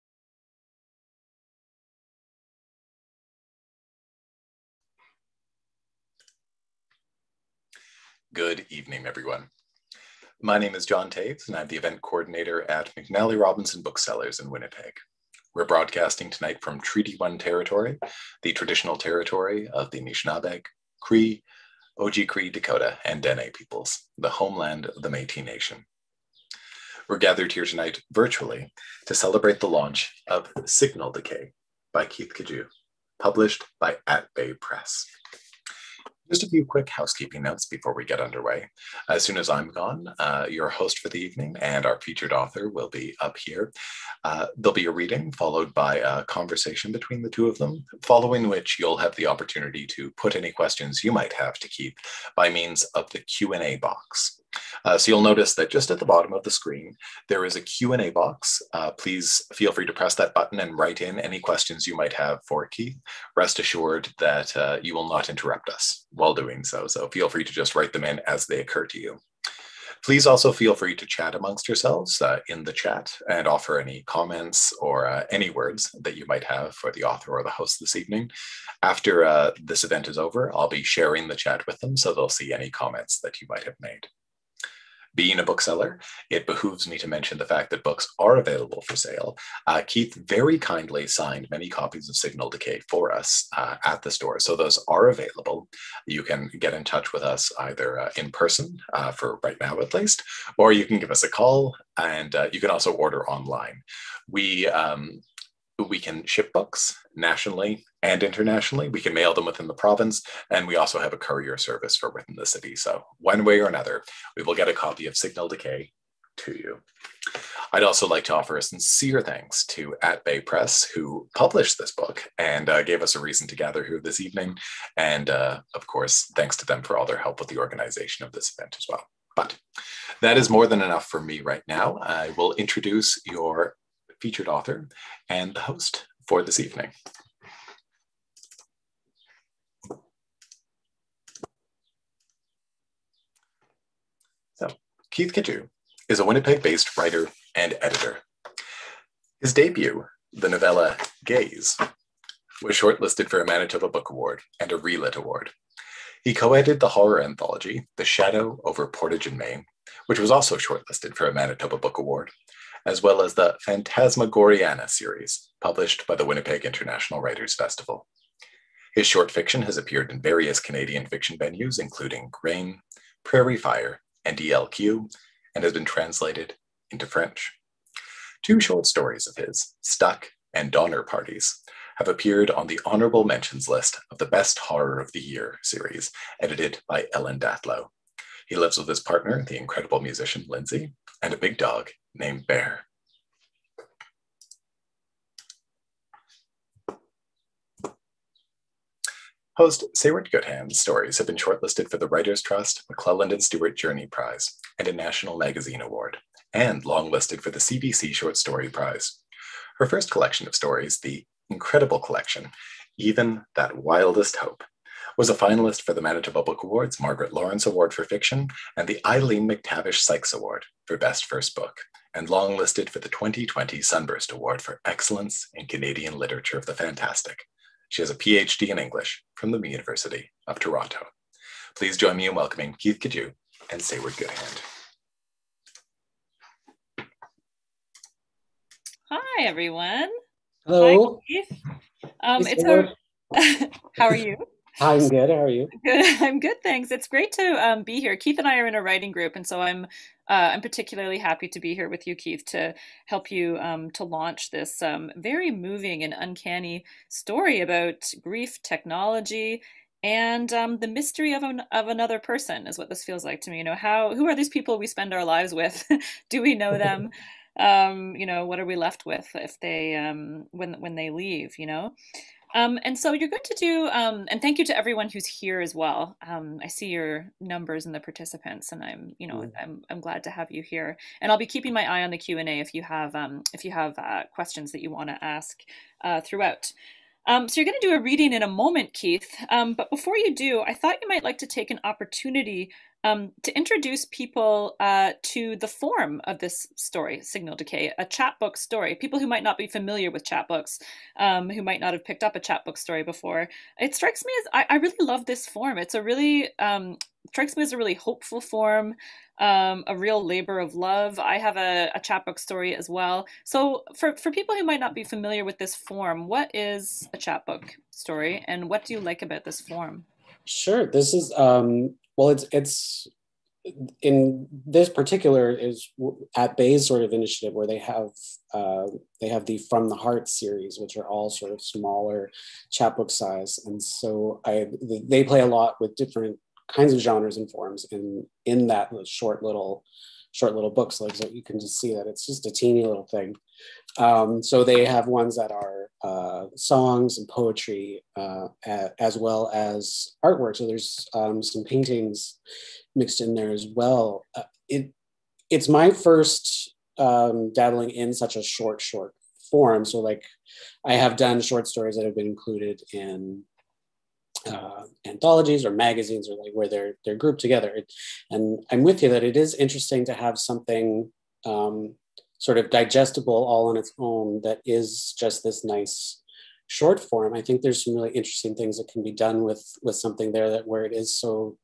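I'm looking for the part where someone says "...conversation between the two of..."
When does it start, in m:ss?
0:46.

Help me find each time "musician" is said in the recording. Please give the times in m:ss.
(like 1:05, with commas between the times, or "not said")
3:09.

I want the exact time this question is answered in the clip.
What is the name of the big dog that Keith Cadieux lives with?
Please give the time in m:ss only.
3:12.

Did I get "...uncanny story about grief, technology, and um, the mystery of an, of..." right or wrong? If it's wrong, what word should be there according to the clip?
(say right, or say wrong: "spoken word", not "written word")
right.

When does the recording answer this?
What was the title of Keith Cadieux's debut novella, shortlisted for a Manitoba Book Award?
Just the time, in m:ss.
2:31.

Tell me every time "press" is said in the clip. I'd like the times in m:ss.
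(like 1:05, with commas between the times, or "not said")
0:34, 0:59, 2:00.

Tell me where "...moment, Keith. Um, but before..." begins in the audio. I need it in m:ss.
4:48.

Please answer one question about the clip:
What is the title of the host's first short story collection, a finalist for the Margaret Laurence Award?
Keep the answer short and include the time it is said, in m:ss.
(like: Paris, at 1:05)
Even That Wildest Hope, at 3:32.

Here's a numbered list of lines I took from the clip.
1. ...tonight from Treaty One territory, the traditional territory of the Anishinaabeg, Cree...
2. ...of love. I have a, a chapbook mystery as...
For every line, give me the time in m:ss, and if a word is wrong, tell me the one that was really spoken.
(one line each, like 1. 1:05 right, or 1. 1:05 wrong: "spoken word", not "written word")
1. 0:16 right
2. 5:10 wrong: "story", not "mystery".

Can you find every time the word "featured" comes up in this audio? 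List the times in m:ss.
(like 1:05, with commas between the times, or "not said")
0:42, 2:14.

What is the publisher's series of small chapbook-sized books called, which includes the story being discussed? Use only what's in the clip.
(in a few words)
From the Heart.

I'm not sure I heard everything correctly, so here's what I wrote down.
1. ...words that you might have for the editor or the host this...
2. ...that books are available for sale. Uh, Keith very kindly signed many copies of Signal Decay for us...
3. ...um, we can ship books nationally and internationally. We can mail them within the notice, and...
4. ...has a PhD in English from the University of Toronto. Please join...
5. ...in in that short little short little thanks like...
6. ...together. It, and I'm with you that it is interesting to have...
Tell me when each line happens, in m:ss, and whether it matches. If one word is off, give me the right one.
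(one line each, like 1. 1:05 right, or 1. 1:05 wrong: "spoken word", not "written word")
1. 1:15 wrong: "author", not "editor"
2. 1:27 right
3. 1:44 wrong: "province", not "notice"
4. 3:48 right
5. 5:37 wrong: "books", not "thanks"
6. 6:07 right.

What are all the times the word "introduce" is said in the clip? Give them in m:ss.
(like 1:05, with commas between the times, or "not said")
2:12, 4:53.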